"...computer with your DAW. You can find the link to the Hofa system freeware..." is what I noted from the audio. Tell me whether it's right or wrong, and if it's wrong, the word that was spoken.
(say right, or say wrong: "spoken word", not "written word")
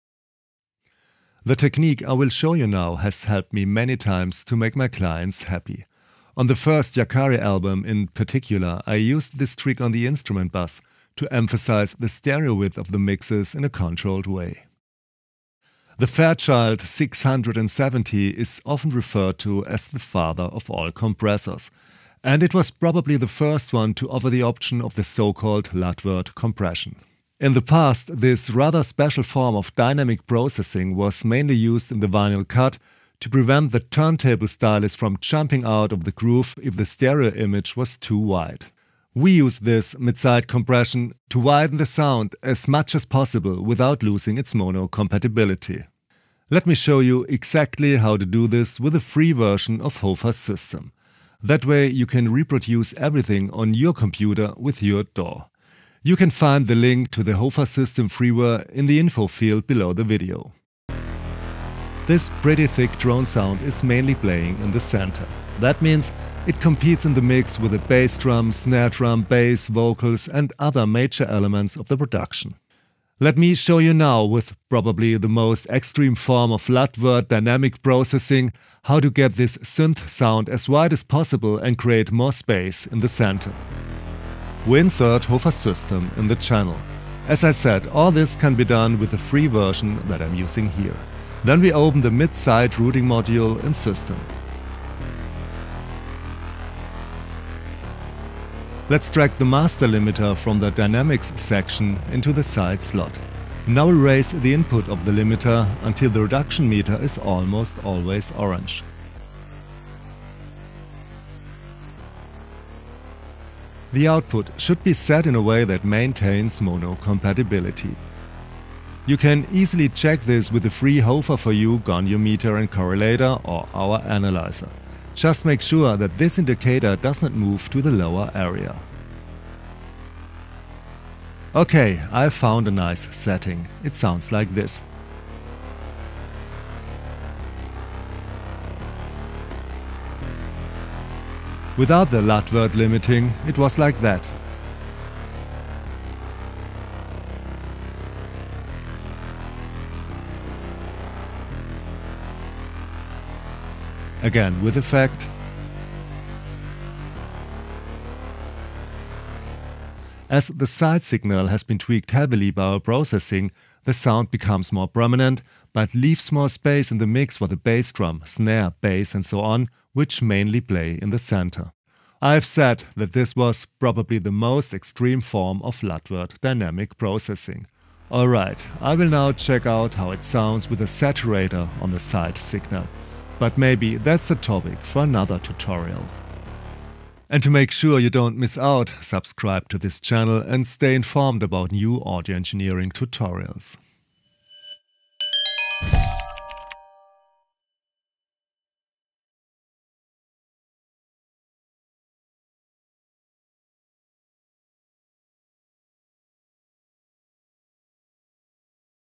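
right.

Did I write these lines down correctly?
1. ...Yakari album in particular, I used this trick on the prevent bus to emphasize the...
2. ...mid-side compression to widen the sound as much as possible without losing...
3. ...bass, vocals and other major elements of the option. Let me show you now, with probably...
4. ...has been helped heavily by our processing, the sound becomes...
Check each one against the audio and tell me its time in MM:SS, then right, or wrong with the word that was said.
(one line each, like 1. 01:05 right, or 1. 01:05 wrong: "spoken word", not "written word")
1. 00:06 wrong: "instrument", not "prevent"
2. 00:39 right
3. 01:09 wrong: "production", not "option"
4. 02:41 wrong: "tweaked", not "helped".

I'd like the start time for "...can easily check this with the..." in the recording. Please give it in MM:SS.
01:59.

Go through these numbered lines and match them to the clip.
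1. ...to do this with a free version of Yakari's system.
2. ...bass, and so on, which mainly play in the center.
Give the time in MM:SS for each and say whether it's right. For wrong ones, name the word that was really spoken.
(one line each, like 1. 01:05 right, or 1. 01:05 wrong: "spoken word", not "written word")
1. 00:48 wrong: "HOFA", not "Yakari"
2. 02:48 right.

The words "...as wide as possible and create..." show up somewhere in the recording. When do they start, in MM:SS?
01:20.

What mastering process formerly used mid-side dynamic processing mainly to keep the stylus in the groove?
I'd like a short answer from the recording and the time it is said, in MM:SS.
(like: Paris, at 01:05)
vinyl cut, at 00:32.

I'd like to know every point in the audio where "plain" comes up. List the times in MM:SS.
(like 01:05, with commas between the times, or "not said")
not said.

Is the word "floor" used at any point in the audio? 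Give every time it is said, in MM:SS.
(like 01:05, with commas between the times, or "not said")
not said.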